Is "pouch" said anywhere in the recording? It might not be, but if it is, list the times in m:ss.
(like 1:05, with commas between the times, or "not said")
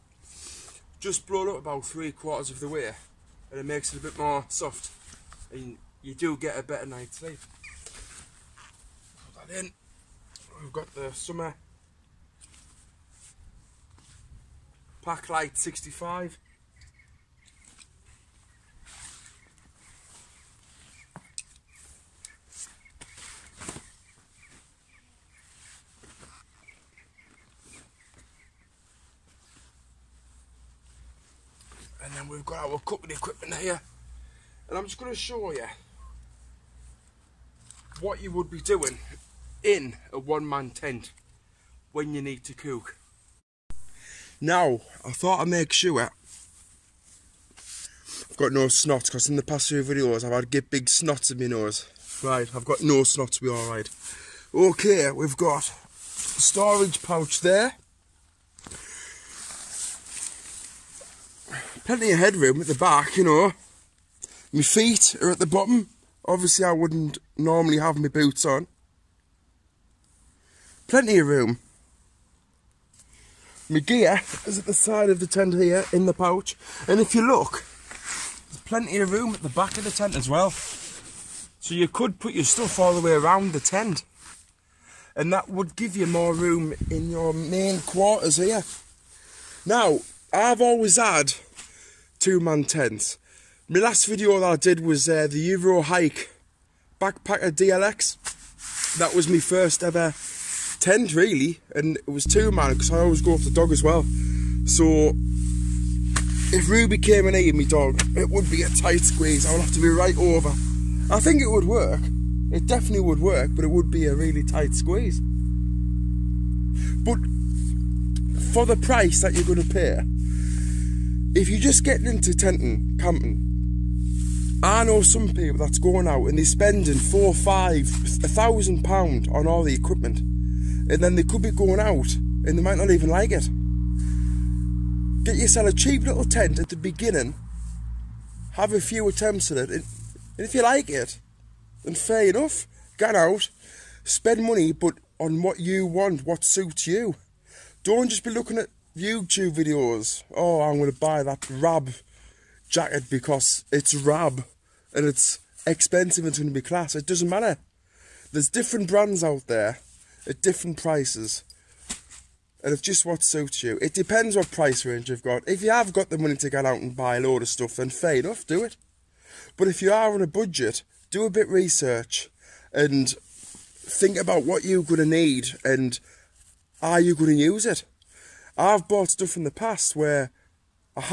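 0:57, 1:16.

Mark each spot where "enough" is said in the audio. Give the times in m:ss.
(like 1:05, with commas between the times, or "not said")
2:22, 2:48.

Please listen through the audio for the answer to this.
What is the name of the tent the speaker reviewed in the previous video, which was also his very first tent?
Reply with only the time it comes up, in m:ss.
1:35.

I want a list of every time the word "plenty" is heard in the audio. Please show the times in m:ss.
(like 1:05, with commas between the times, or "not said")
1:01, 1:10, 1:18.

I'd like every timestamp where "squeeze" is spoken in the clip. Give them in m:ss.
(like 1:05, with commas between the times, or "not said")
1:49, 1:54.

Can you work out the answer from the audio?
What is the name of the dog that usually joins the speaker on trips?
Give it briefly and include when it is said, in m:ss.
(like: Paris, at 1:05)
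Ruby, at 1:46.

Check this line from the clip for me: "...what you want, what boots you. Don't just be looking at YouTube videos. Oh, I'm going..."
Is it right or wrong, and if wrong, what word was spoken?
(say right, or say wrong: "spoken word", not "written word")
wrong: "suits", not "boots".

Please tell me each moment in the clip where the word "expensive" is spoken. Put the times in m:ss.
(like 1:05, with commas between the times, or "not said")
2:35.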